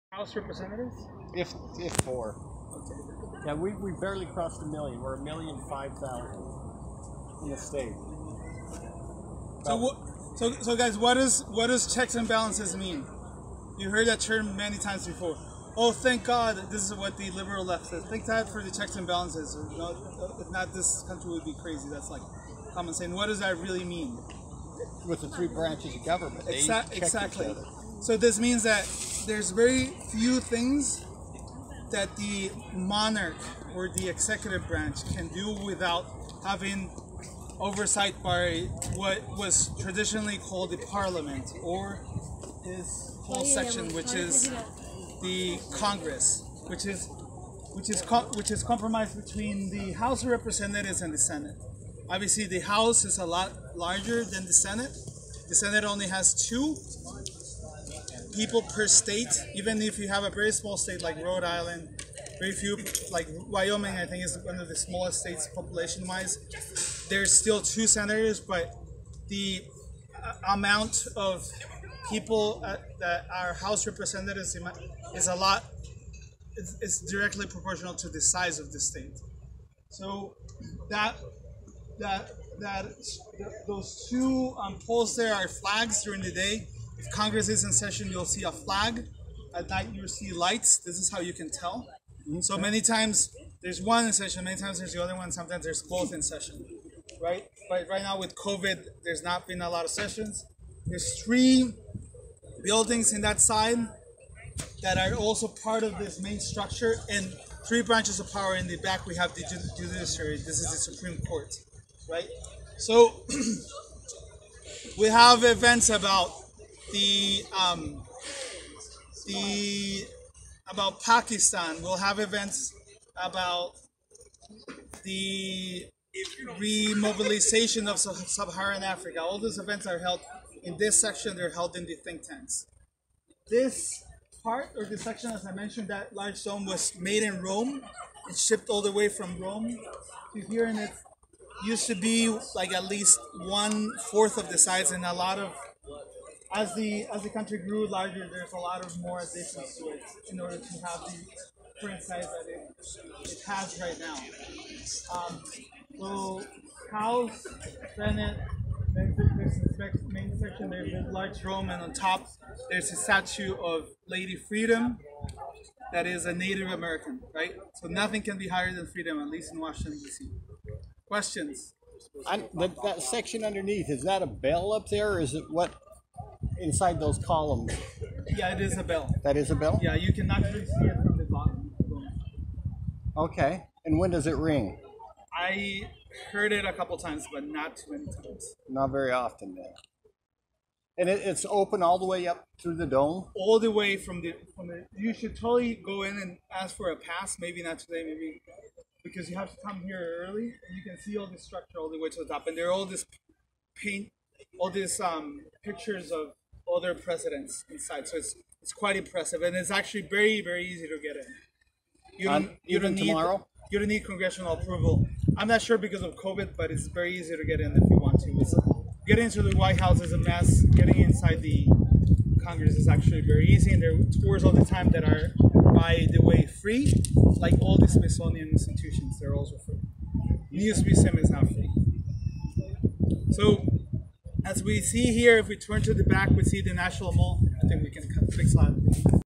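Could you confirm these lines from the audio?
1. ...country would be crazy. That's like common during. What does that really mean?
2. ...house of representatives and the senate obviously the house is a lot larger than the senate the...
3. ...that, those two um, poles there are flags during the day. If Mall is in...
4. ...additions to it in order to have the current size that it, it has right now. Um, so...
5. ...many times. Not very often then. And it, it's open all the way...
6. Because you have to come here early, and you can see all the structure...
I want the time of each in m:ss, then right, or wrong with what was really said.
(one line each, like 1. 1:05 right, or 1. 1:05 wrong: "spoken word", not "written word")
1. 0:21 wrong: "saying", not "during"
2. 0:49 right
3. 1:22 wrong: "Congress", not "Mall"
4. 2:29 right
5. 3:07 right
6. 3:19 right.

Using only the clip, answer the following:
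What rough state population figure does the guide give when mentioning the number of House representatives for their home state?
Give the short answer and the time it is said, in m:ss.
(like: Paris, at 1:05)
1,005,000, at 0:05.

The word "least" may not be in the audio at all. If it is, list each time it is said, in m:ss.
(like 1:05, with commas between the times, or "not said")
2:22, 2:49.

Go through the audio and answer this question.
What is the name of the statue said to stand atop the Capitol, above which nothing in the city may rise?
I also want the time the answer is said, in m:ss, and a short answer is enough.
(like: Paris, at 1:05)
Lady Freedom, at 2:44.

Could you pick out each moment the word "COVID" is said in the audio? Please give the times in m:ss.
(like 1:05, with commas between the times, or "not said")
1:38, 3:36.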